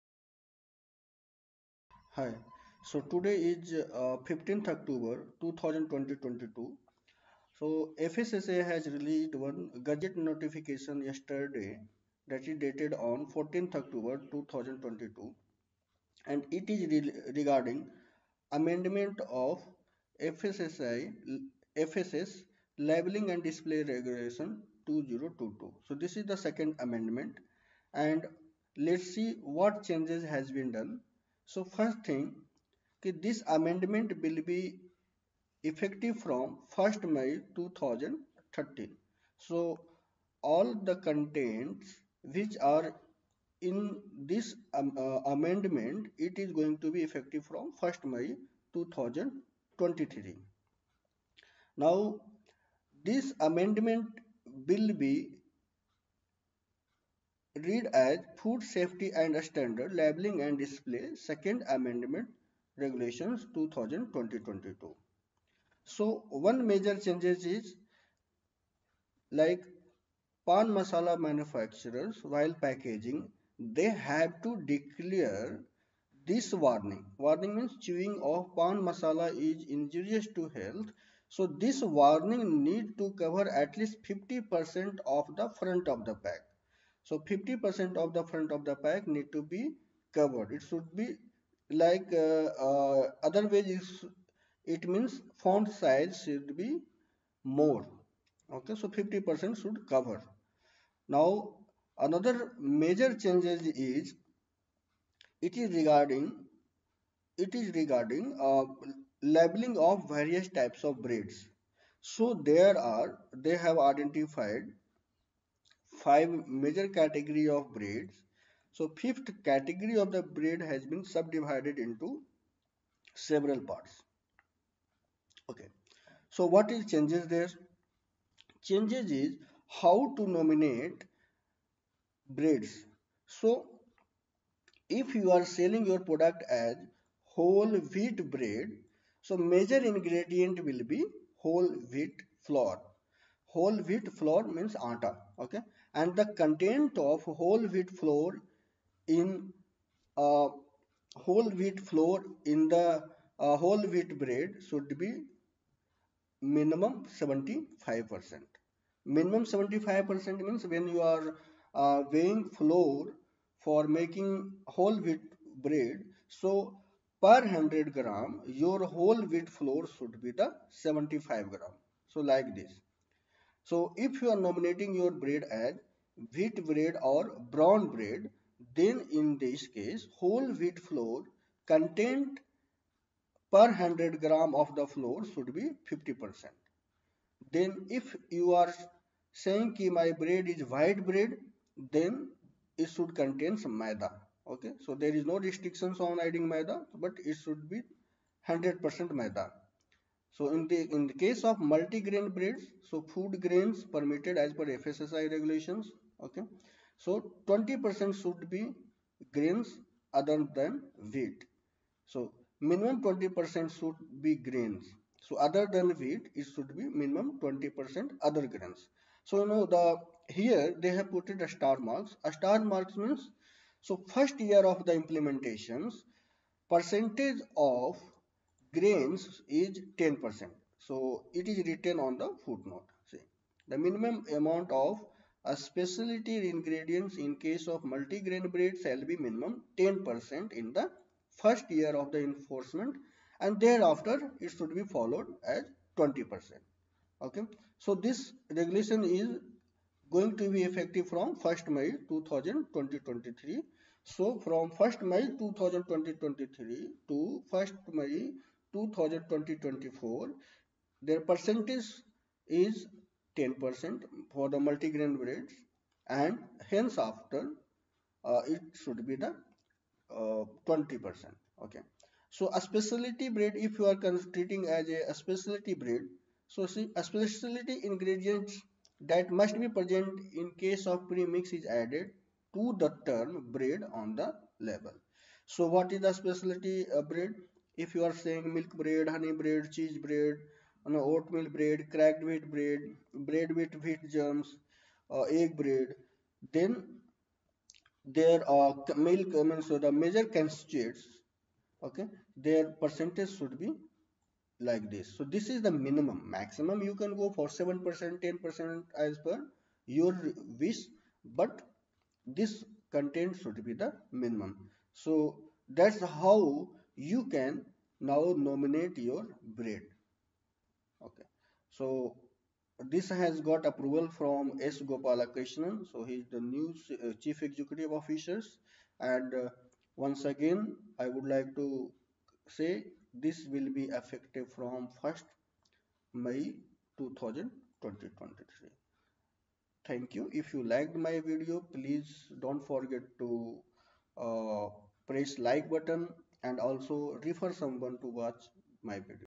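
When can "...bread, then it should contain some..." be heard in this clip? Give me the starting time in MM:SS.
03:11.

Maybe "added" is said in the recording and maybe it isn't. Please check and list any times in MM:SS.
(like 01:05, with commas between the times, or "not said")
04:41.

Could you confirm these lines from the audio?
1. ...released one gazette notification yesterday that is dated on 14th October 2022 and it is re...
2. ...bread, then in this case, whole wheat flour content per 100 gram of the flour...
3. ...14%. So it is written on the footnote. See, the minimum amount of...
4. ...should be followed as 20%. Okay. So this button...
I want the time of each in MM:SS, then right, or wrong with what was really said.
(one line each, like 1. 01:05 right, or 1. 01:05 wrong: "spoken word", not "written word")
1. 00:08 right
2. 02:57 right
3. 03:49 wrong: "10", not "14"
4. 04:04 wrong: "regulation", not "button".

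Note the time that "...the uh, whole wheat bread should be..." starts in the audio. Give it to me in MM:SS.
02:32.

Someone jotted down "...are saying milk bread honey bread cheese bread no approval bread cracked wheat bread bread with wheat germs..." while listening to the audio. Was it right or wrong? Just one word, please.
wrong.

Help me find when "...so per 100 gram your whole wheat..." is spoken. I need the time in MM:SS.
02:46.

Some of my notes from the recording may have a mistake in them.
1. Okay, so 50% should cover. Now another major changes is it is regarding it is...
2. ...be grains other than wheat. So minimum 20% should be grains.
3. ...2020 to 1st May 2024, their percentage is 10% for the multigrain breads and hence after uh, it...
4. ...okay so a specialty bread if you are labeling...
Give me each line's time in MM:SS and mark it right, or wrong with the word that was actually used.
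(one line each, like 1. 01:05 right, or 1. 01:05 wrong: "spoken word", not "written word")
1. 01:38 right
2. 03:28 right
3. 04:15 wrong: "2023", not "2020"
4. 04:31 wrong: "treating", not "labeling".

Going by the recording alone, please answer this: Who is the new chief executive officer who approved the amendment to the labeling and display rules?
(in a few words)
S. Gopalakrishnan.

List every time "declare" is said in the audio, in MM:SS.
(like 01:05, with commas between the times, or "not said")
01:14.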